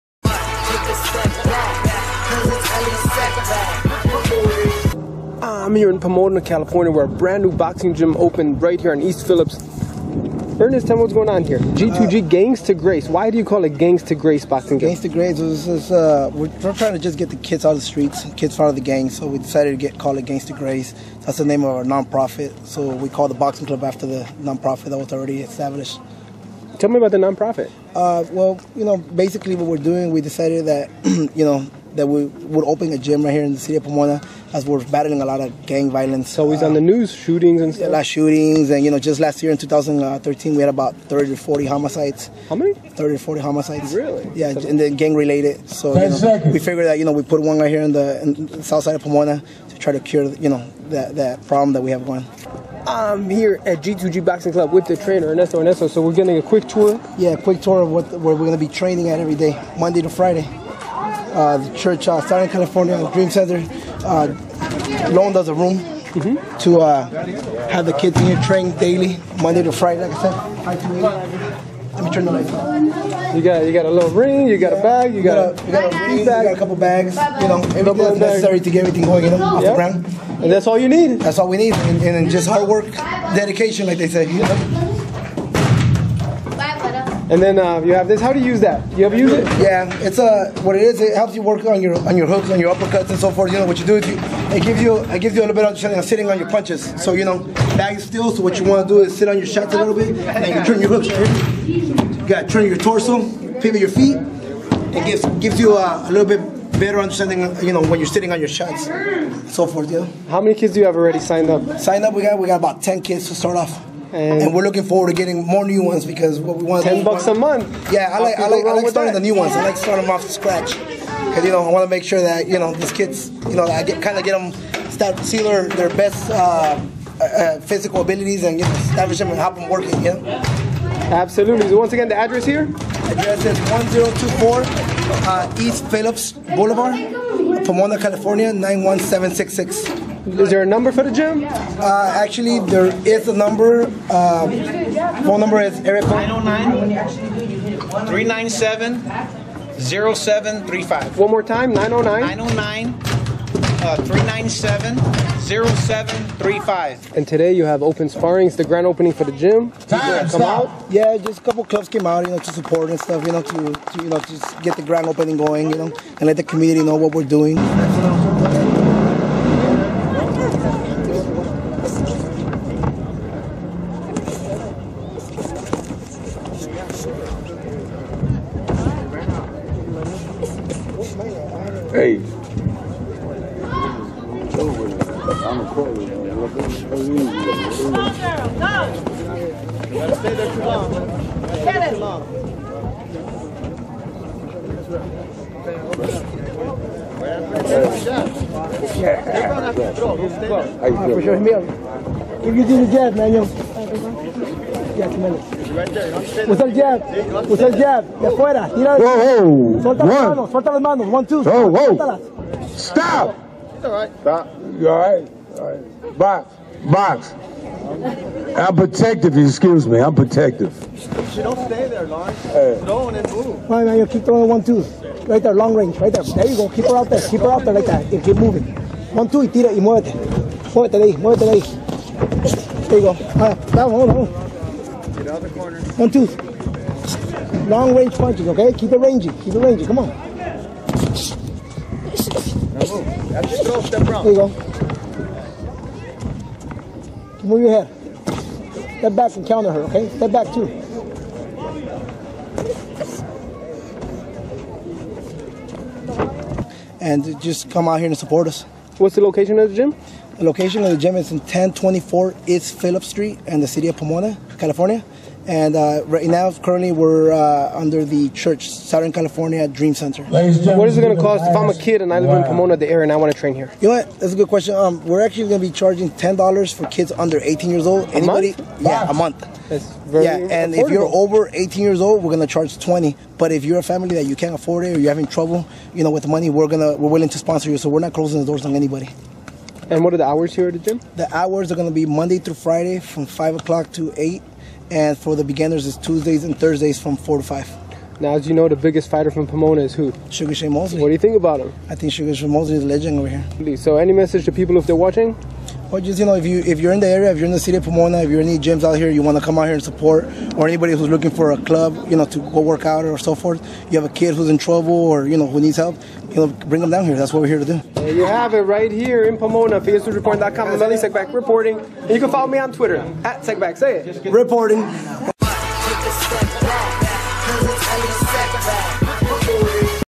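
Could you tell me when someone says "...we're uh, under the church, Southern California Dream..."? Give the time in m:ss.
4:26.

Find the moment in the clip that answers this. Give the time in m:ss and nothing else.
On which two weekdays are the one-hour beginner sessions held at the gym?
4:55.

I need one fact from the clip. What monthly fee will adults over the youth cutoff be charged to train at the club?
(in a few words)
$20.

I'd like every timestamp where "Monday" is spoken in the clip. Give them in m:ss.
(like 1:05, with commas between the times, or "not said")
0:59, 1:09, 4:52.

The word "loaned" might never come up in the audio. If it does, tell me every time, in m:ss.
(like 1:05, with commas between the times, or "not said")
1:05.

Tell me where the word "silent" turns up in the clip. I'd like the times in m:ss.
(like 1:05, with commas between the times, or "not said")
not said.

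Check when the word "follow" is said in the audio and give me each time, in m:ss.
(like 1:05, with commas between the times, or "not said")
5:22.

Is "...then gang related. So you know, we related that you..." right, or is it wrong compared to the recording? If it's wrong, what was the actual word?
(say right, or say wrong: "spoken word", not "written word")
wrong: "figured", not "related".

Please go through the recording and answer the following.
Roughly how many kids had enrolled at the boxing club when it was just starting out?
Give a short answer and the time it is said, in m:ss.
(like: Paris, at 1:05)
10, at 1:52.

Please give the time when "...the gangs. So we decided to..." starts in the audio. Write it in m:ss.
0:18.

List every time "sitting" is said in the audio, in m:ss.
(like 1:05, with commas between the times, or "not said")
1:36, 1:48.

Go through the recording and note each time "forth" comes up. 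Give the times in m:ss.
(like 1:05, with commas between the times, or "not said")
1:33, 1:49, 5:13.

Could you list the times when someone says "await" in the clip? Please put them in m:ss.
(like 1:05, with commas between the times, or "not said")
not said.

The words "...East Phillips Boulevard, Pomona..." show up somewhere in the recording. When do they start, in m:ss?
2:15.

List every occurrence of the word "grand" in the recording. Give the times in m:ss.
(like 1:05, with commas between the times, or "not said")
2:38, 2:44.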